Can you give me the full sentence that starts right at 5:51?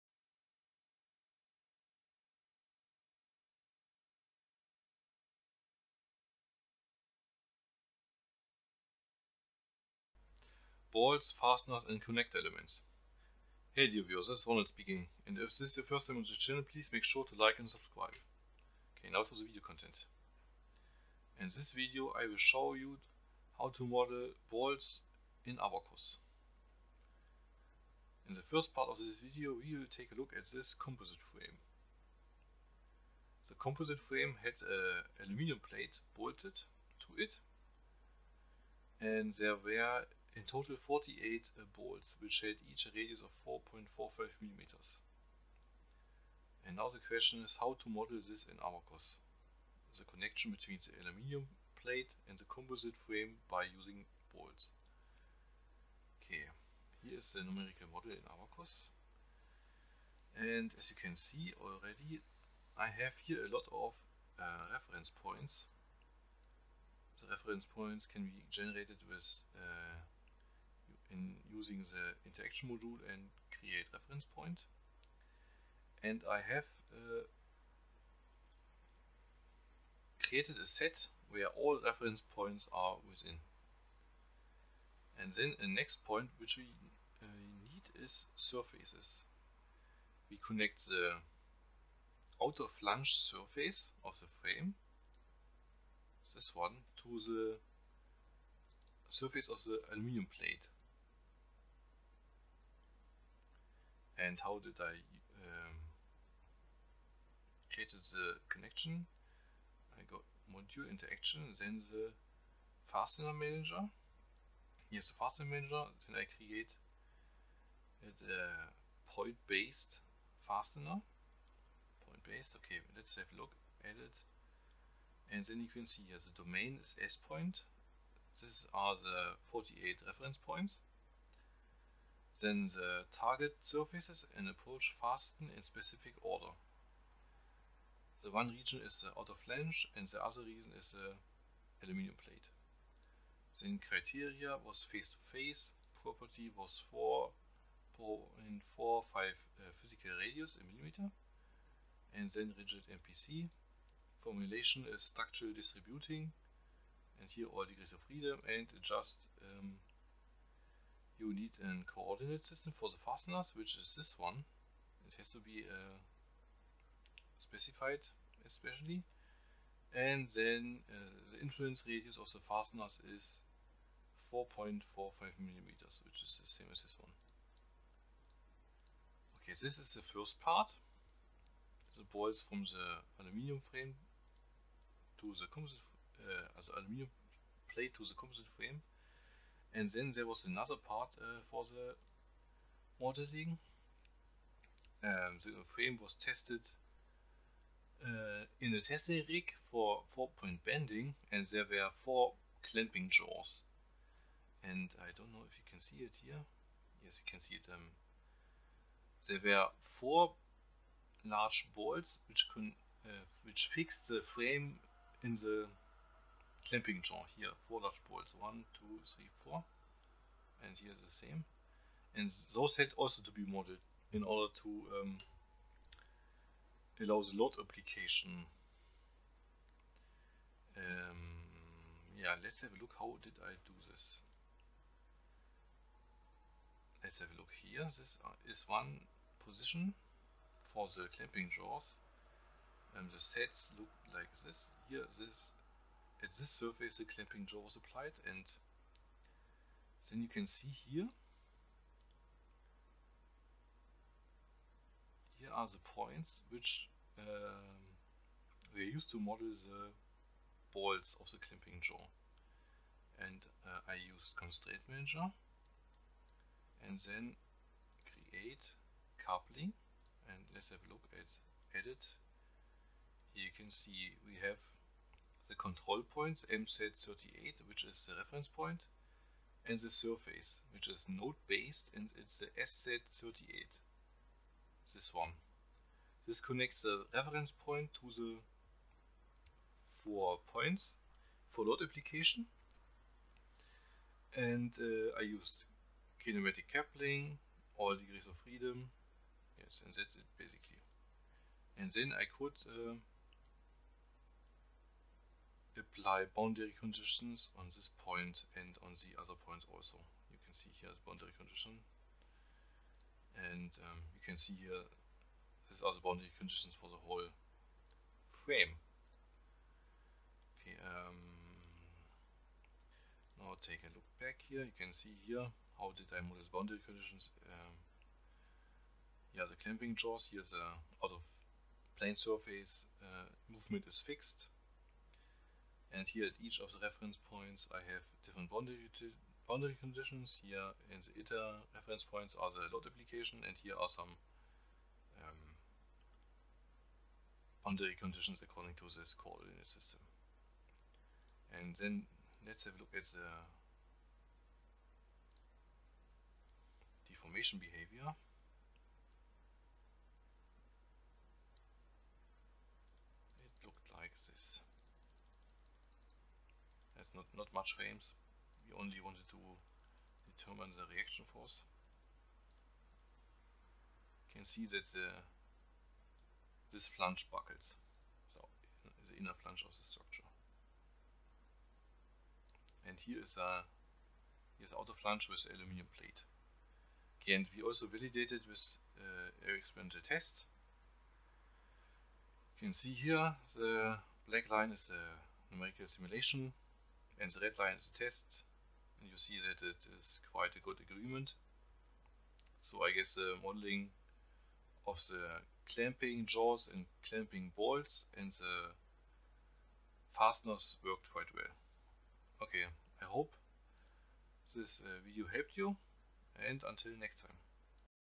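And then let's have a look at the deformation behavior.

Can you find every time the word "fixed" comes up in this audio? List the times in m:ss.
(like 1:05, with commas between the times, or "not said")
3:33, 5:34.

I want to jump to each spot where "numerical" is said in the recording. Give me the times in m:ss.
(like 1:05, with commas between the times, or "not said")
0:57, 6:35.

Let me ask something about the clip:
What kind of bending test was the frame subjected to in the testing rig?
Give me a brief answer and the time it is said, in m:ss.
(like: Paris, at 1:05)
four-point bending, at 3:20.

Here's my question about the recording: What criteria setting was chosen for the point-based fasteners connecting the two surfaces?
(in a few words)
face to face.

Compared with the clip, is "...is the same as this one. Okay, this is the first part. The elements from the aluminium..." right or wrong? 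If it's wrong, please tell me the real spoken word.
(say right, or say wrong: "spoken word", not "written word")
wrong: "bolts", not "elements".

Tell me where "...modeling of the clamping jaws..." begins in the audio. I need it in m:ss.
6:43.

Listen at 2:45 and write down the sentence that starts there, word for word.
It has to be uh, specified especially.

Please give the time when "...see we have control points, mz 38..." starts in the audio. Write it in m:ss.
4:33.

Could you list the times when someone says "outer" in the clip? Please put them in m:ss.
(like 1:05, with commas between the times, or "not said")
1:32, 2:19, 6:24.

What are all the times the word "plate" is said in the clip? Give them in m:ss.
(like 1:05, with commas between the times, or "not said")
0:35, 0:51, 1:40, 2:22, 3:07, 6:25.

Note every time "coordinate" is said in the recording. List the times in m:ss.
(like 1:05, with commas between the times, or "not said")
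2:41, 5:49.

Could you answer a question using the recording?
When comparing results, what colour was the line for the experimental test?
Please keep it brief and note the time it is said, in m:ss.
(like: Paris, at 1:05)
red, at 6:37.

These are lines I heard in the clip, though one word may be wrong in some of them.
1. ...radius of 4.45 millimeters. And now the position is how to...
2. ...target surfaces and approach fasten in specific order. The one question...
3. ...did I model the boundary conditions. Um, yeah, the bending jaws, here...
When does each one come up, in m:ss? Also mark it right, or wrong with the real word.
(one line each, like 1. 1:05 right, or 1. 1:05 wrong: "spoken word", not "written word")
1. 0:42 wrong: "question", not "position"
2. 2:13 wrong: "region", not "question"
3. 5:25 wrong: "clamping", not "bending".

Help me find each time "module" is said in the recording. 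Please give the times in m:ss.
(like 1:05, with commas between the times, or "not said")
1:12, 1:50.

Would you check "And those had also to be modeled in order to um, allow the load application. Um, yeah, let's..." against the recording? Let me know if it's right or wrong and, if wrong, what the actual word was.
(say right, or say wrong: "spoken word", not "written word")
right.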